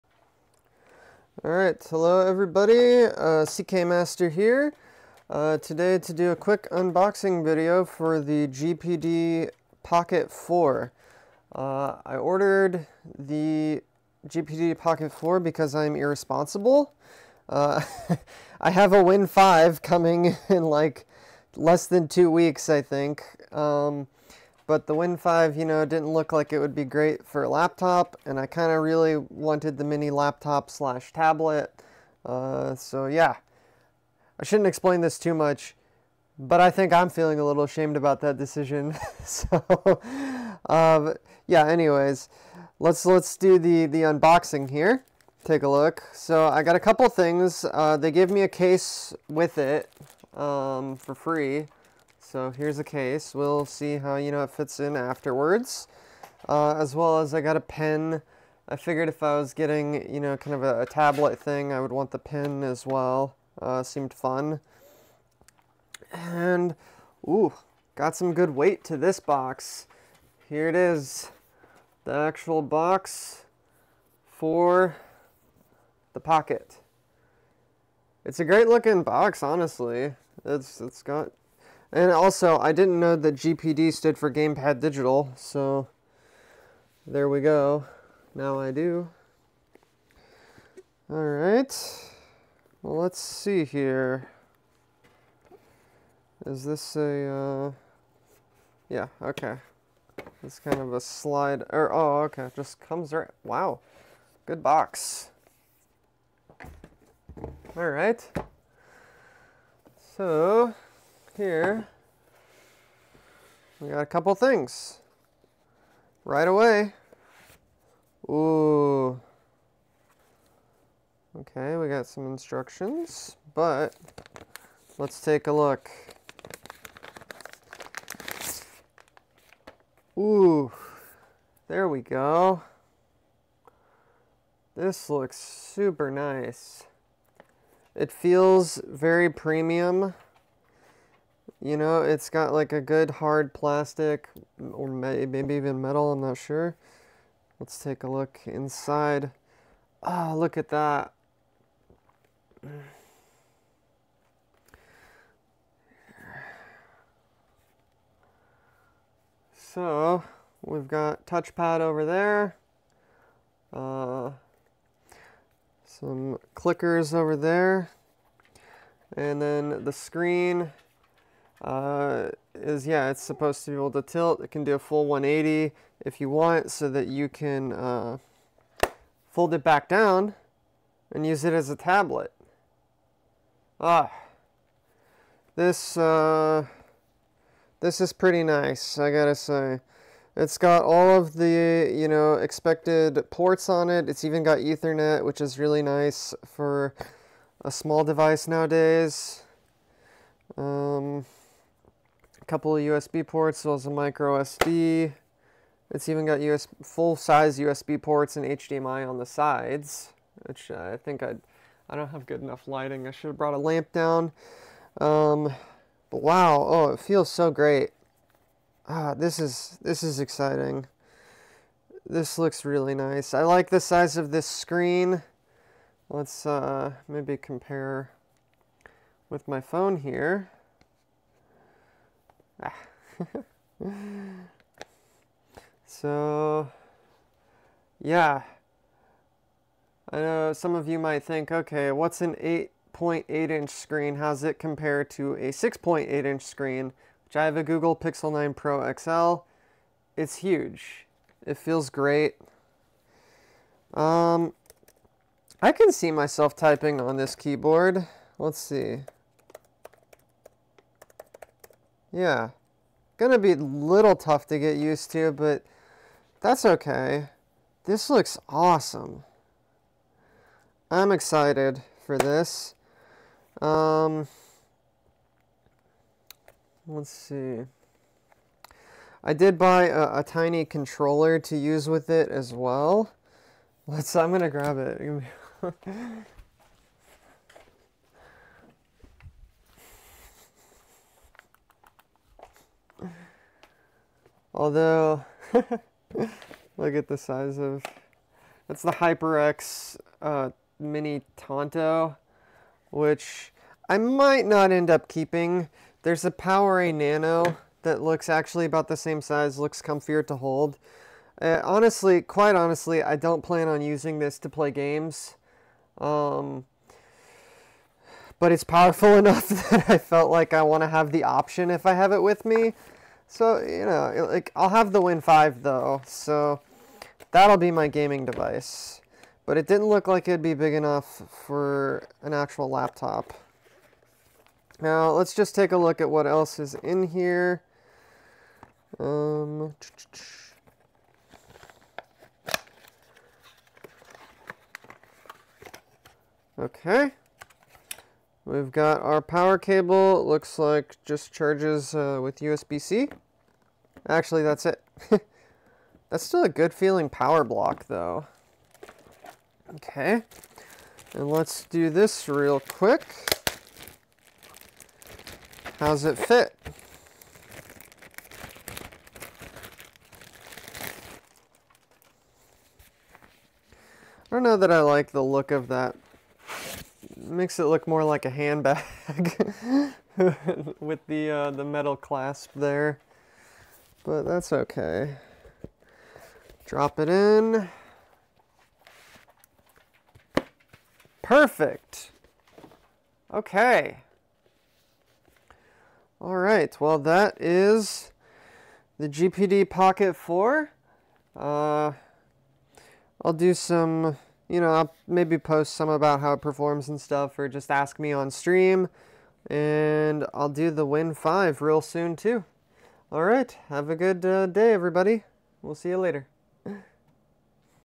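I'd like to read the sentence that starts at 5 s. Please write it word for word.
Uh, today to do a quick unboxing video for the GPD Pocket 4.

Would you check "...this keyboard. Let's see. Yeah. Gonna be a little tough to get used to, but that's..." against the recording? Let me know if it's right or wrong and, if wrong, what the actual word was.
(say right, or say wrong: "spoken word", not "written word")
right.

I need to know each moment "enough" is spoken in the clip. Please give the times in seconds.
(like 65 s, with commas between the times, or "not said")
212 s, 319 s, 330 s.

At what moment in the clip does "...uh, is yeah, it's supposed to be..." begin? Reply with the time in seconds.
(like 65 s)
171 s.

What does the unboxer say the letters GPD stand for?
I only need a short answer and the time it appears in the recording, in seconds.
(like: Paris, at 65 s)
Gamepad Digital, at 84 s.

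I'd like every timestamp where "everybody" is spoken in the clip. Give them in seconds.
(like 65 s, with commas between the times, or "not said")
2 s, 414 s.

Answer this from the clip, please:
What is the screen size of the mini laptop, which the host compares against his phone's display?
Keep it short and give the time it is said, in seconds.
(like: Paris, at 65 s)
8.8 inch, at 242 s.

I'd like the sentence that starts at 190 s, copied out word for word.
It's got all of the, you know, expected ports on it.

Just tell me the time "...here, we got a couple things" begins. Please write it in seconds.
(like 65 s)
111 s.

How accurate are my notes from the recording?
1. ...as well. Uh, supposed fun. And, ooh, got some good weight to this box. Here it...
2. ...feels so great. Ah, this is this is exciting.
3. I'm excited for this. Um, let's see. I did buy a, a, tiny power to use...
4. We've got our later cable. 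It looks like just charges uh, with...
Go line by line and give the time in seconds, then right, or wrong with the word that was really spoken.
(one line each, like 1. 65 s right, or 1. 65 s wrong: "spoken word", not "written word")
1. 62 s wrong: "seemed", not "supposed"
2. 216 s right
3. 270 s wrong: "controller", not "power"
4. 348 s wrong: "power", not "later".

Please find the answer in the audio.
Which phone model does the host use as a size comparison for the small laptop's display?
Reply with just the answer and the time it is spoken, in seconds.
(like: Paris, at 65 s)
Google Pixel 9 Pro XL, at 247 s.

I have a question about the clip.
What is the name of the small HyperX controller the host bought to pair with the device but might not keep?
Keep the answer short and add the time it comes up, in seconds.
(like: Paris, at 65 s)
Mini Tanto, at 300 s.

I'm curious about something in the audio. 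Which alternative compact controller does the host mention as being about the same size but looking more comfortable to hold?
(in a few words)
Power Nano.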